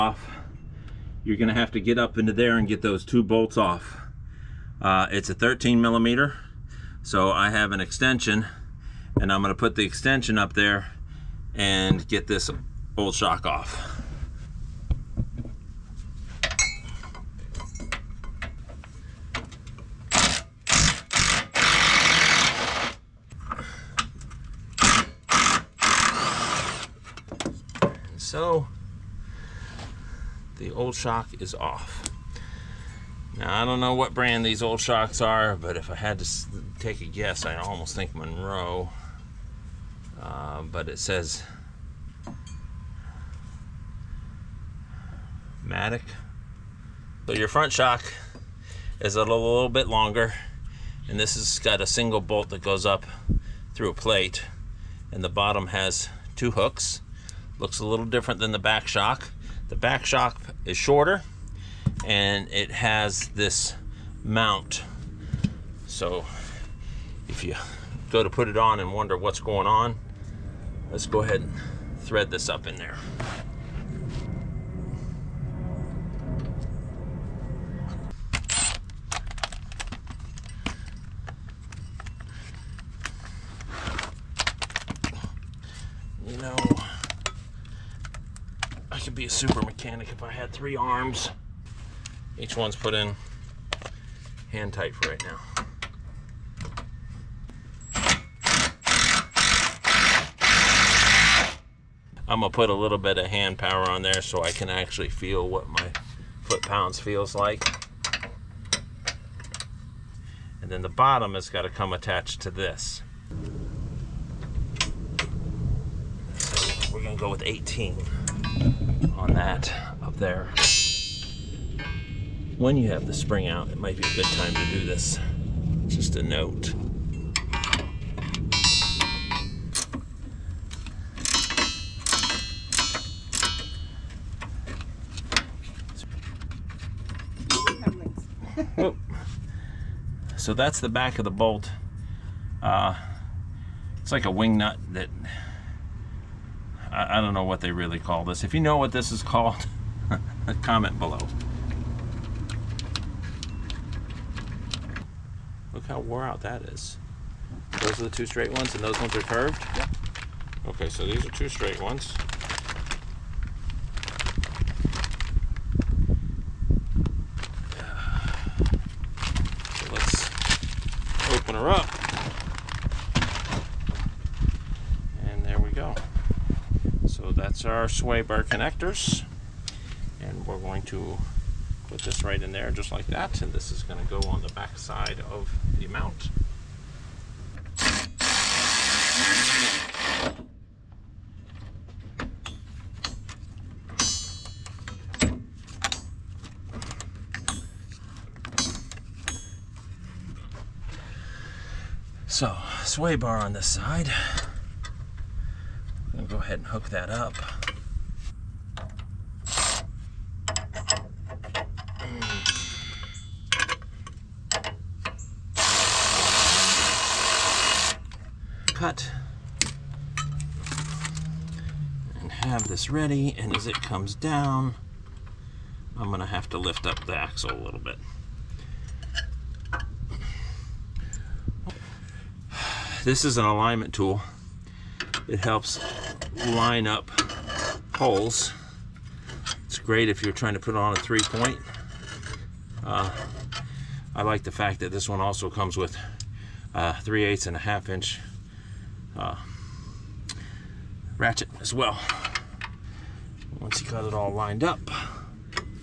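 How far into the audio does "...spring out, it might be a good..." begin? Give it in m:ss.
2:03.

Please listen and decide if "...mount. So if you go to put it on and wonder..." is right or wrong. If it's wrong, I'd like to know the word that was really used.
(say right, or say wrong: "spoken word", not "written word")
right.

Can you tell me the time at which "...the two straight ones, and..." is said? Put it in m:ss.
2:38.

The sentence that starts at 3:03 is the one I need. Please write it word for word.
And this is going to go on the back side of the mount.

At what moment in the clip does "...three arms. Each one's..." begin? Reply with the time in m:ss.
1:30.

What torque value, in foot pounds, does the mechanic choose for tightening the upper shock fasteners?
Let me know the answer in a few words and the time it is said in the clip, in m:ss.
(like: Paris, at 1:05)
18, at 1:57.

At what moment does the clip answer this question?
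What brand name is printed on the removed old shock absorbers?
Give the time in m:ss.
0:45.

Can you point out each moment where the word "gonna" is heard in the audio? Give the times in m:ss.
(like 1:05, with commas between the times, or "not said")
0:01, 0:09, 1:42, 1:57.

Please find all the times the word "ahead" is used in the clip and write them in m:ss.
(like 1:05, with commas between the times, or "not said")
1:11, 3:26.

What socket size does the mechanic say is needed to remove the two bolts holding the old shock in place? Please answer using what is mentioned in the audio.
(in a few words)
13 millimeter.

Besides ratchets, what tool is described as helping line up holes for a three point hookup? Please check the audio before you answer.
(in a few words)
alignment tool.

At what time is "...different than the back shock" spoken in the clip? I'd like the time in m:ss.
0:58.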